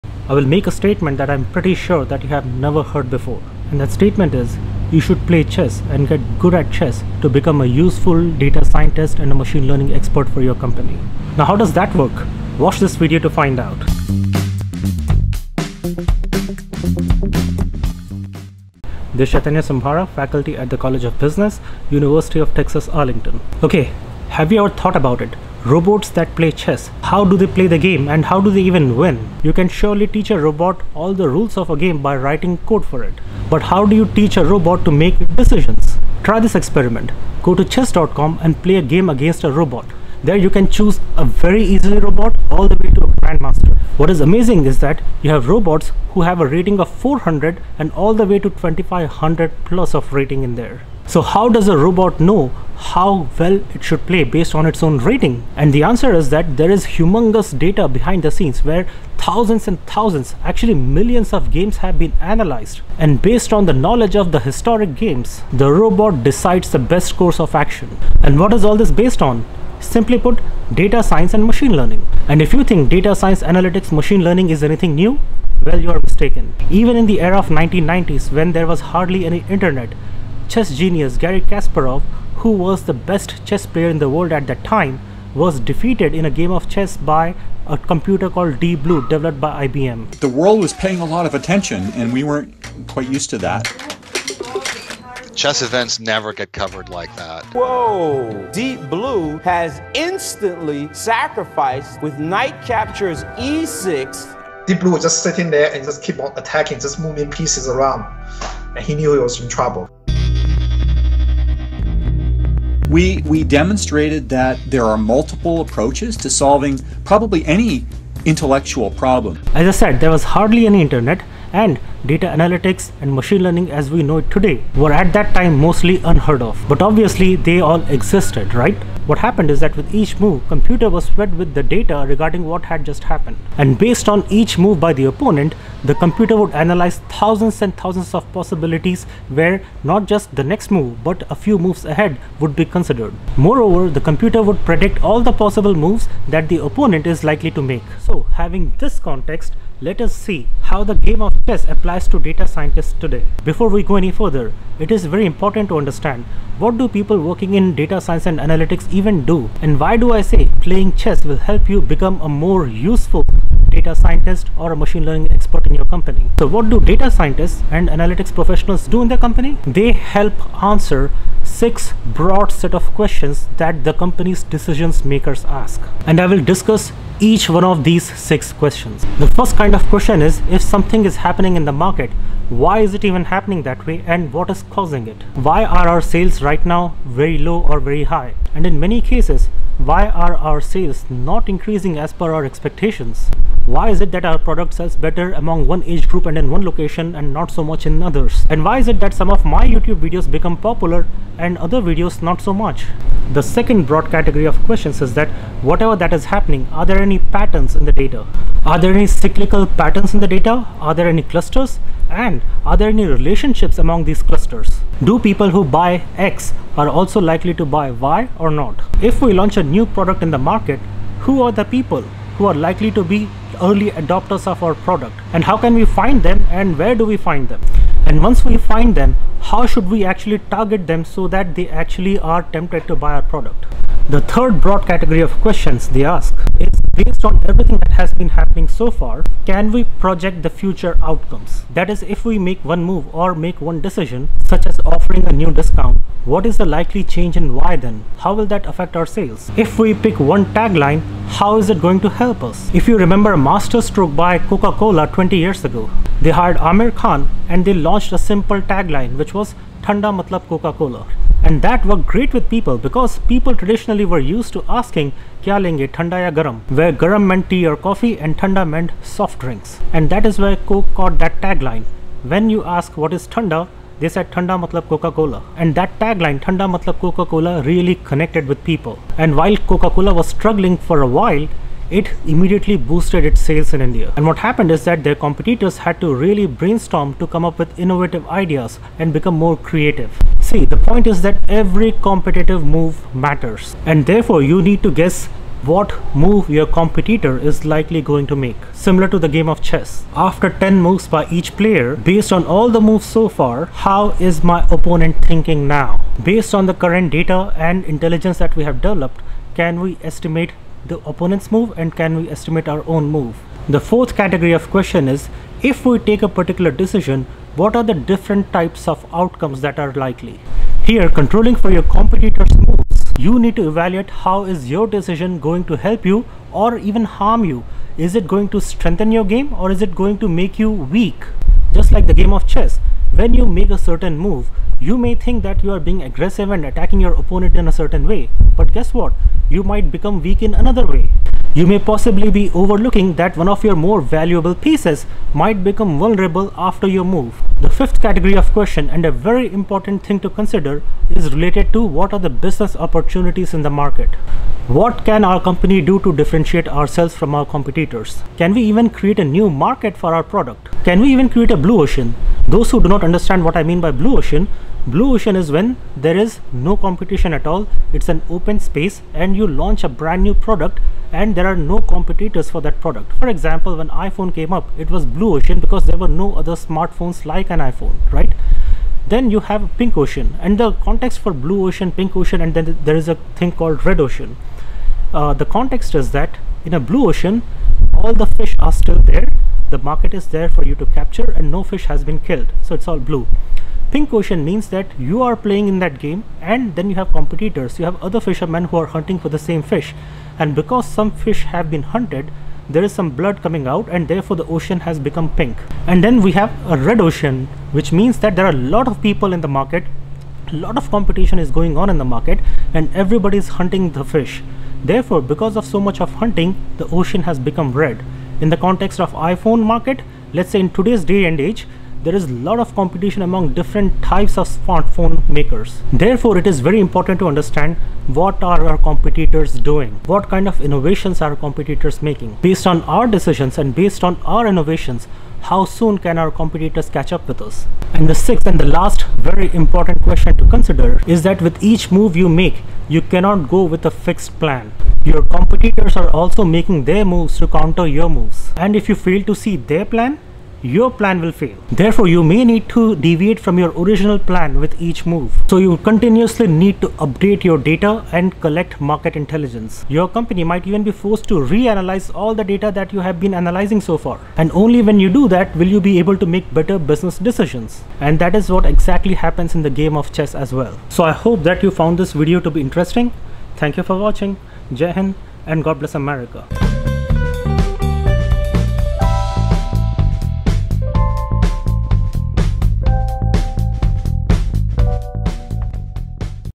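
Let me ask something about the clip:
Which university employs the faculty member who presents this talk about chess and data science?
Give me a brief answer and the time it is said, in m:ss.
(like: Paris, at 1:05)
University of Texas, Arlington, at 0:21.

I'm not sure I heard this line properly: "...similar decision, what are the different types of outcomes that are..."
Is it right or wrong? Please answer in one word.
wrong.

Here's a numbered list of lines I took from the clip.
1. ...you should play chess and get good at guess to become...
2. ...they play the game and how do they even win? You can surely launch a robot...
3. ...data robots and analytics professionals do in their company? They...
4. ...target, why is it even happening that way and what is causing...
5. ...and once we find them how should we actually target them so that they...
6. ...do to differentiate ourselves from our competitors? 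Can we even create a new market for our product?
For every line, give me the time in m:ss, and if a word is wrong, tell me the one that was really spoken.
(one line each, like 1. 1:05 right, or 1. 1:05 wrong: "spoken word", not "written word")
1. 0:04 wrong: "chess", not "guess"
2. 0:27 wrong: "teach", not "launch"
3. 2:46 wrong: "scientists", not "robots"
4. 3:01 wrong: "market", not "target"
5. 3:48 right
6. 5:55 right.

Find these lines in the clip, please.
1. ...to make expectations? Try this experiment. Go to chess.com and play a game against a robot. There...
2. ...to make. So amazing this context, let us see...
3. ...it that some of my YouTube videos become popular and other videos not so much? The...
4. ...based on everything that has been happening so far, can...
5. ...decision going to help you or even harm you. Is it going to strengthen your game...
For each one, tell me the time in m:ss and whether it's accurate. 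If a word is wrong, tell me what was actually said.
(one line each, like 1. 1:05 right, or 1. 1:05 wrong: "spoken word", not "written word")
1. 0:34 wrong: "decisions", not "expectations"
2. 2:27 wrong: "having", not "amazing"
3. 3:18 right
4. 3:57 right
5. 5:24 right.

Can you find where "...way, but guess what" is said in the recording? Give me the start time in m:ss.
5:38.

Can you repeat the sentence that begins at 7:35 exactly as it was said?
So you continuously need to update your data and collect market intelligence.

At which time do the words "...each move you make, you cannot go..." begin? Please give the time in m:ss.
7:21.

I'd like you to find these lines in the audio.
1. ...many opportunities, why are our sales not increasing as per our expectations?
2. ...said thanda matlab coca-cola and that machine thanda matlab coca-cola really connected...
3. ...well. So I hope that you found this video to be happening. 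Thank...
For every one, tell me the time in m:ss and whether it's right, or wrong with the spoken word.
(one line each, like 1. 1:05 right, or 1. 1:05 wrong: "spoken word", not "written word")
1. 3:08 wrong: "cases", not "opportunities"
2. 4:34 wrong: "tagline", not "machine"
3. 7:50 wrong: "interesting", not "happening".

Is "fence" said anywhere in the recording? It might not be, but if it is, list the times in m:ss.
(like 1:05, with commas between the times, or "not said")
not said.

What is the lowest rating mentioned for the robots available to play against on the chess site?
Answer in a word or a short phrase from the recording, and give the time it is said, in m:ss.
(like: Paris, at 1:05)
400, at 0:46.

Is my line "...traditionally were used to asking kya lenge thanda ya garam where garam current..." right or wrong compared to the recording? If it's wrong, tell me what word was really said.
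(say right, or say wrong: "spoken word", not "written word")
wrong: "meant", not "current".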